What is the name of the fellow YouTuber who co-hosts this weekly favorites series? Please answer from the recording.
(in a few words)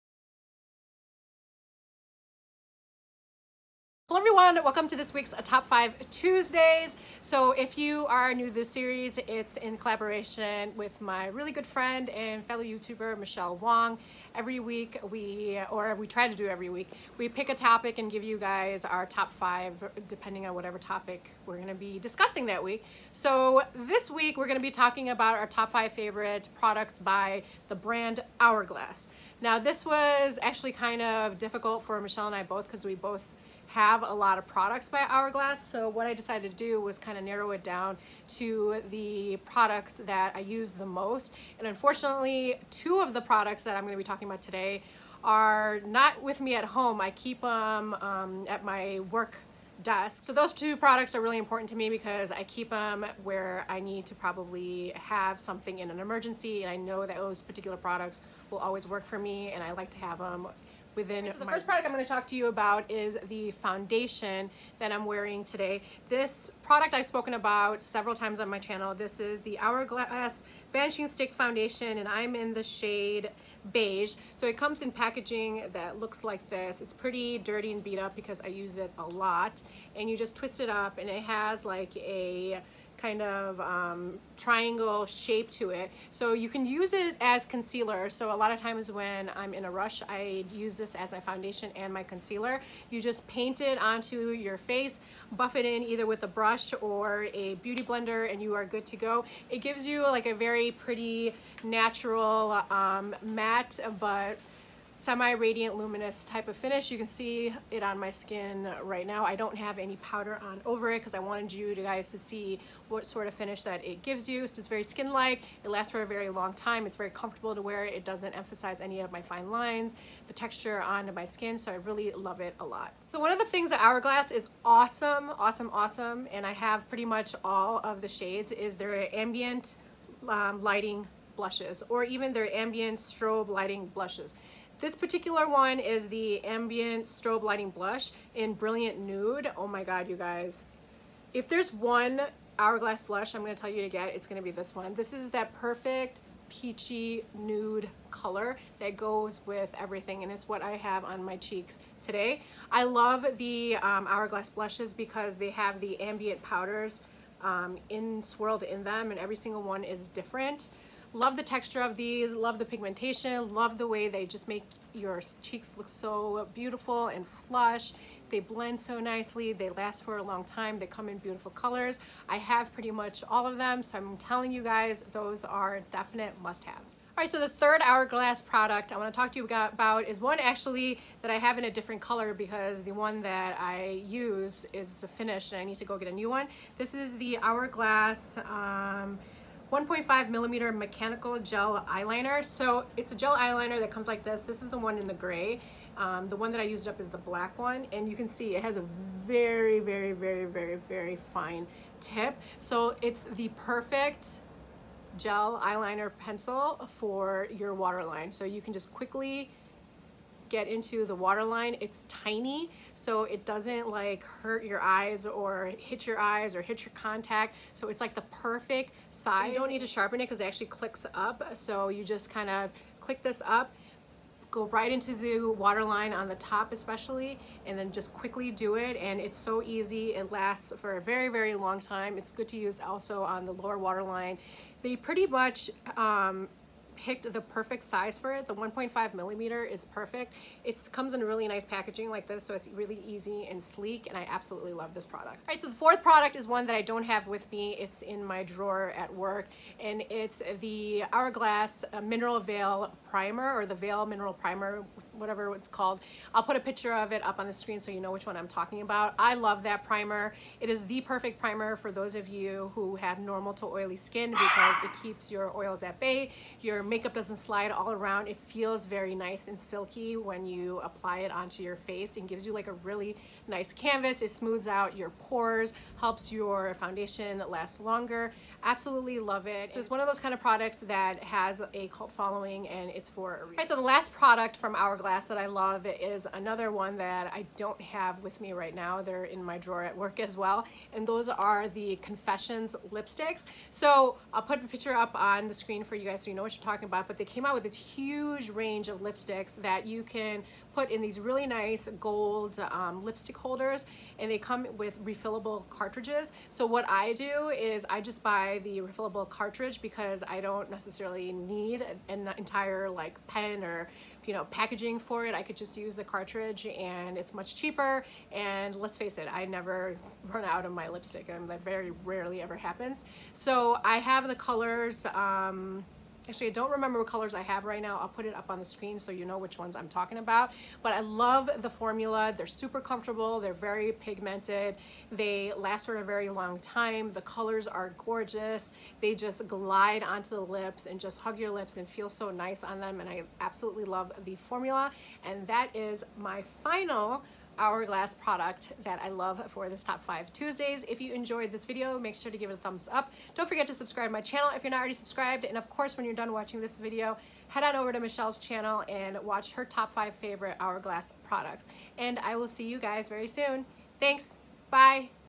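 Michele Wang.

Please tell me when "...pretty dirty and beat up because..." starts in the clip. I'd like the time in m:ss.
1:16.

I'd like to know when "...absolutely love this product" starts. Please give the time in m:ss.
4:04.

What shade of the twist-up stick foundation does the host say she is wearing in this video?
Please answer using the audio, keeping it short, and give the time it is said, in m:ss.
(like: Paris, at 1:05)
Beige, at 1:13.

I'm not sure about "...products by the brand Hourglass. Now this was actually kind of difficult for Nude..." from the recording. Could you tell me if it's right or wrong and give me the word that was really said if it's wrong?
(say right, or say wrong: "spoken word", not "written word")
wrong: "Michelle", not "Nude".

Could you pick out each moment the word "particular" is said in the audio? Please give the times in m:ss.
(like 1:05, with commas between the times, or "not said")
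0:57, 2:14.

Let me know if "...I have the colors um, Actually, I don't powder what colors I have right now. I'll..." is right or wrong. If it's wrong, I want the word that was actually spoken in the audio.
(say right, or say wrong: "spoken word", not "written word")
wrong: "remember", not "powder".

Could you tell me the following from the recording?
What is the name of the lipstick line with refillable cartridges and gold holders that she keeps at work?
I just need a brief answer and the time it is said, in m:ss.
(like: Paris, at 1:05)
Confessions, at 4:52.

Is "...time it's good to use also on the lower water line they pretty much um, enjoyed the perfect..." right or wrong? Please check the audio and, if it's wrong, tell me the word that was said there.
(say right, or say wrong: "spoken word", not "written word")
wrong: "picked", not "enjoyed".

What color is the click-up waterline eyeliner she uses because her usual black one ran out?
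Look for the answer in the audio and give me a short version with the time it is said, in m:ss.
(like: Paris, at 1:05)
Gray, at 3:15.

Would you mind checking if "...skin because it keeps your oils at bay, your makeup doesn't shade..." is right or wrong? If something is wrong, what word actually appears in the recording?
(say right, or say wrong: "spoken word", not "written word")
wrong: "slide", not "shade".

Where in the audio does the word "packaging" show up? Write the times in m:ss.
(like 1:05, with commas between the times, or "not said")
1:14, 4:01, 5:14.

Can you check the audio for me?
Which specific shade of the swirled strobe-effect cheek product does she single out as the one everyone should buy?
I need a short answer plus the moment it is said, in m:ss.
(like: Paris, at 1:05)
Brilliant Nude, at 2:18.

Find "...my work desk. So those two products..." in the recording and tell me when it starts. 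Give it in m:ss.
0:48.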